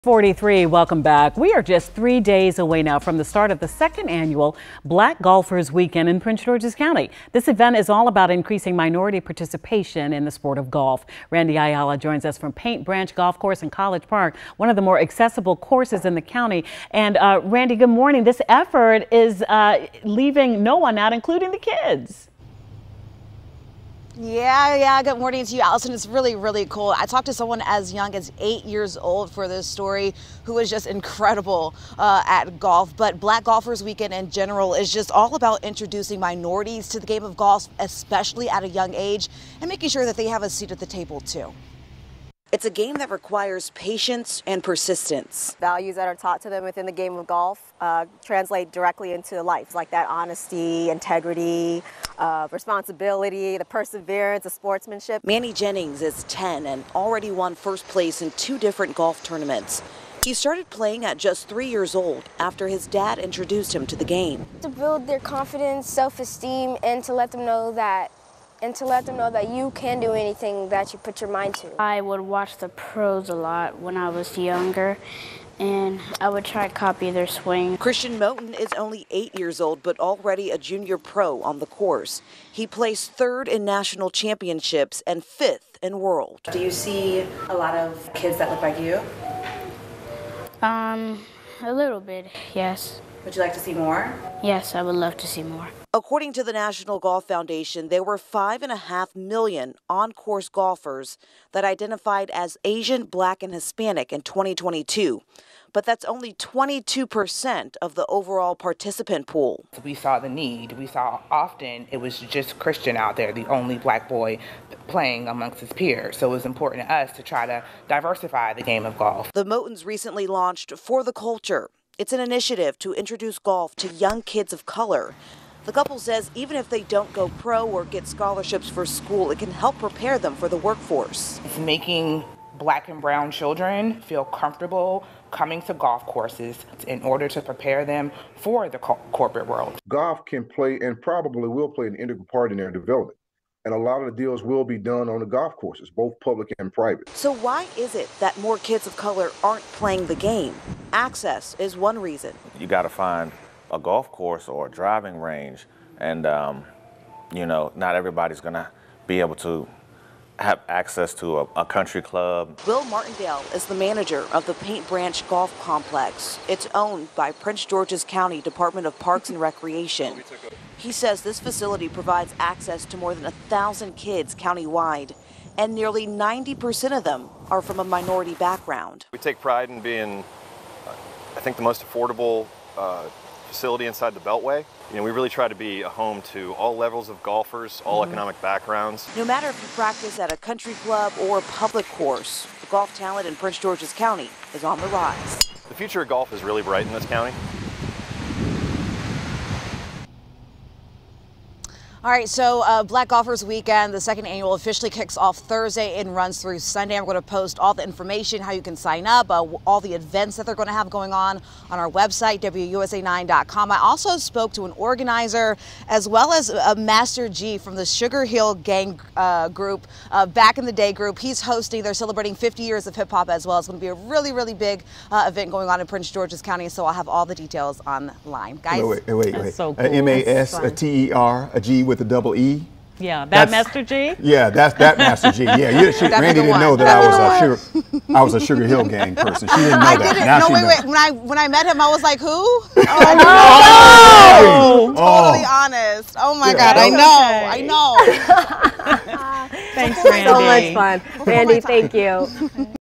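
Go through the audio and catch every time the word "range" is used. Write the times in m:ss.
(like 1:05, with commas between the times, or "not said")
2:35.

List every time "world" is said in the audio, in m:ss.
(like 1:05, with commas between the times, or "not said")
1:25, 2:19.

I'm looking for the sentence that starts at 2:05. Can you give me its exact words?
The couple says even if they don't go pro or get scholarships for school, it can help prepare them for the workforce.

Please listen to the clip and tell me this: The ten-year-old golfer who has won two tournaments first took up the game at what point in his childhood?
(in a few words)
3 years old.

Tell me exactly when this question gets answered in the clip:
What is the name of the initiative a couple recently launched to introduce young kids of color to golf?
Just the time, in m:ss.
2:00.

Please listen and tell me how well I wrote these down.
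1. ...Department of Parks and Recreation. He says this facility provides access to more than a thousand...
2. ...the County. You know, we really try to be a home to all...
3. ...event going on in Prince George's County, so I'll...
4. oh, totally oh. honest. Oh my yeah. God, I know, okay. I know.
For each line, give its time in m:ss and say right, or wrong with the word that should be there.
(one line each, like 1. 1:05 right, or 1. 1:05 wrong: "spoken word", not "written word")
1. 2:48 right
2. 3:04 wrong: "Beltway", not "County"
3. 3:45 right
4. 4:04 right.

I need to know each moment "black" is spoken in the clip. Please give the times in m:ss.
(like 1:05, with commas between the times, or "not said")
0:04, 0:33, 1:43, 1:53, 2:12, 3:22.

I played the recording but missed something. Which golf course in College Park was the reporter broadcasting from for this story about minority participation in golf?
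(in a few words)
Paint Branch Golf Course.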